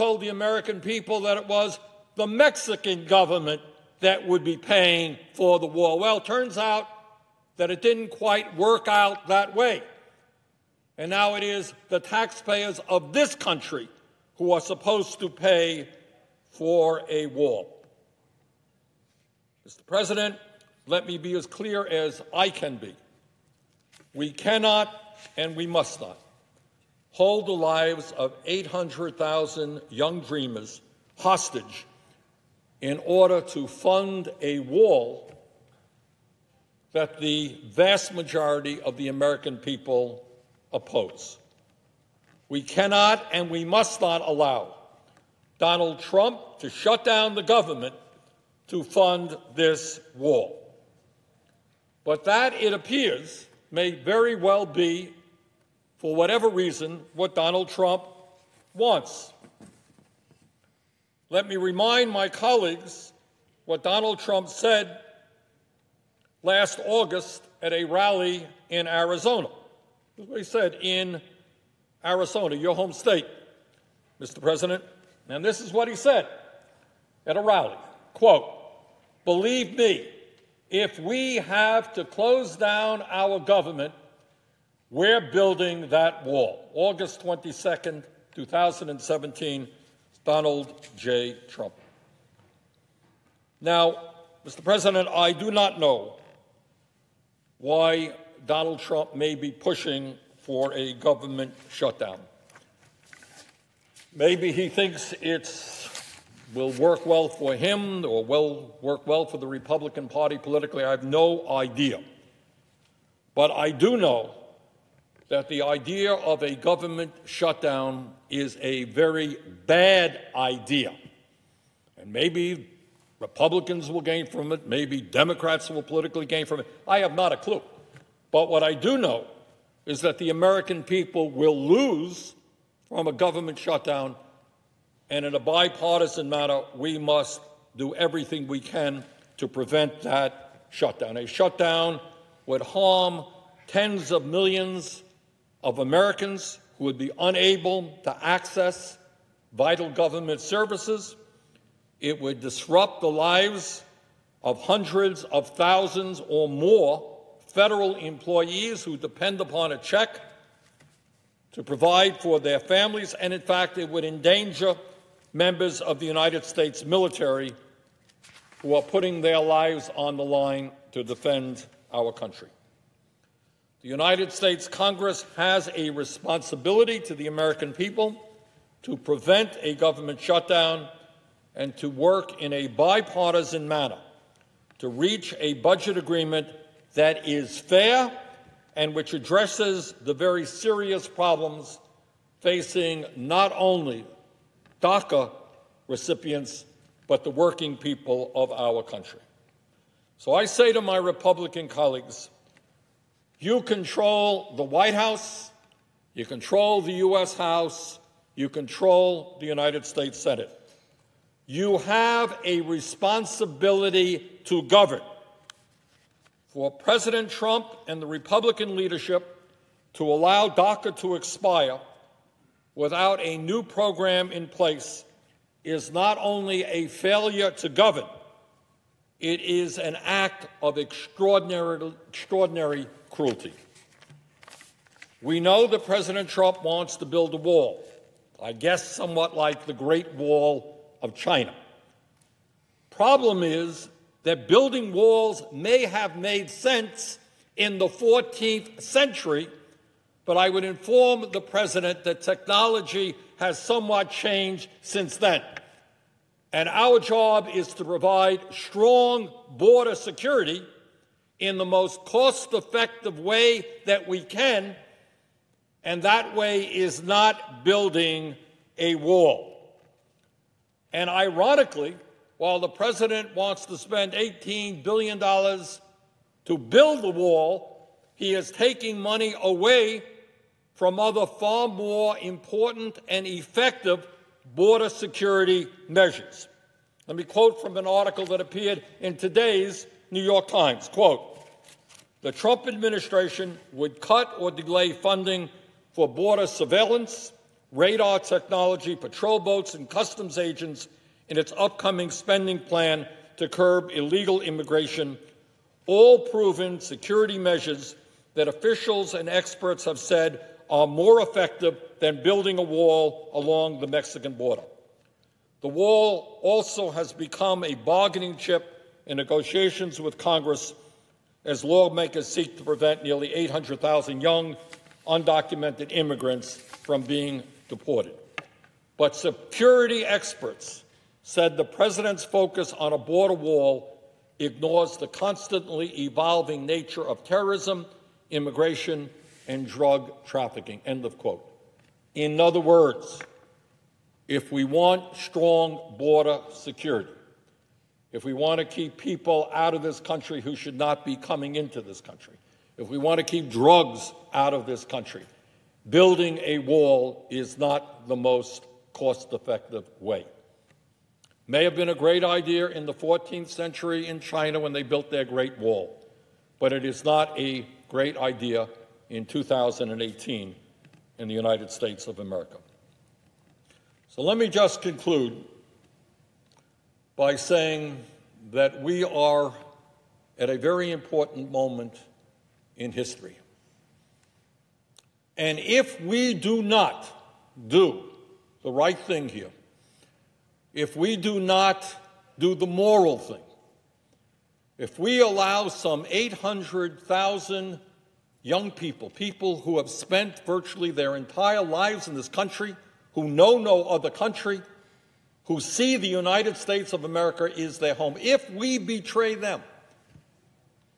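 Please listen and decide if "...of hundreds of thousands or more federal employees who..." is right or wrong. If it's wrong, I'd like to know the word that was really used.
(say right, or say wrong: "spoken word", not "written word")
right.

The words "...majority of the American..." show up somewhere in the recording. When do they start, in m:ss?
0:38.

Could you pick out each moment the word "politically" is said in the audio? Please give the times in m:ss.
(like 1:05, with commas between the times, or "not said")
1:50, 2:05.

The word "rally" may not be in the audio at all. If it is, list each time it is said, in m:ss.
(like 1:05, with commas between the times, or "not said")
1:07, 1:17.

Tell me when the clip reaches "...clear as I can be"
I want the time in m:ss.
0:21.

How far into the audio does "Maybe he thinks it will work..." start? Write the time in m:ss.
1:44.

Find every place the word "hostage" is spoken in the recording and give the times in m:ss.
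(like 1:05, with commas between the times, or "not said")
0:31.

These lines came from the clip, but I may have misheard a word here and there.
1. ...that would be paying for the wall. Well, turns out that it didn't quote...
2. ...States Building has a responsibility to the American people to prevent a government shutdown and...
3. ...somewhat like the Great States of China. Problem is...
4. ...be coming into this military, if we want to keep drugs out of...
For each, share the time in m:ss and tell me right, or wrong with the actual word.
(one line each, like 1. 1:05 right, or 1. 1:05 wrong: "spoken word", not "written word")
1. 0:03 wrong: "quite", not "quote"
2. 2:54 wrong: "Congress", not "Building"
3. 3:58 wrong: "Wall", not "States"
4. 5:51 wrong: "country", not "military".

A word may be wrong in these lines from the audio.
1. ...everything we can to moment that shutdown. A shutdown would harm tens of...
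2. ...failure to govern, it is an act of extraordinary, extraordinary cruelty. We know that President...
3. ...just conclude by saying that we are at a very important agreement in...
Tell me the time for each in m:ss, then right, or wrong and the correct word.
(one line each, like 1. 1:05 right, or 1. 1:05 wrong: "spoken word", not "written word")
1. 2:17 wrong: "prevent", not "moment"
2. 3:46 right
3. 6:14 wrong: "moment", not "agreement".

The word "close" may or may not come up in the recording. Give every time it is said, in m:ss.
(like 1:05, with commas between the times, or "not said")
1:22.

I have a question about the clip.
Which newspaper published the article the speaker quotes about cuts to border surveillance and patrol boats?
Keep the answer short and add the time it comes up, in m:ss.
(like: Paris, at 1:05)
New York Times, at 4:50.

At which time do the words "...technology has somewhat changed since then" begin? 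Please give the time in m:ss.
4:12.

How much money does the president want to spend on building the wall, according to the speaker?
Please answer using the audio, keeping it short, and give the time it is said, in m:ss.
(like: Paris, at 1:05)
$18 billion, at 4:34.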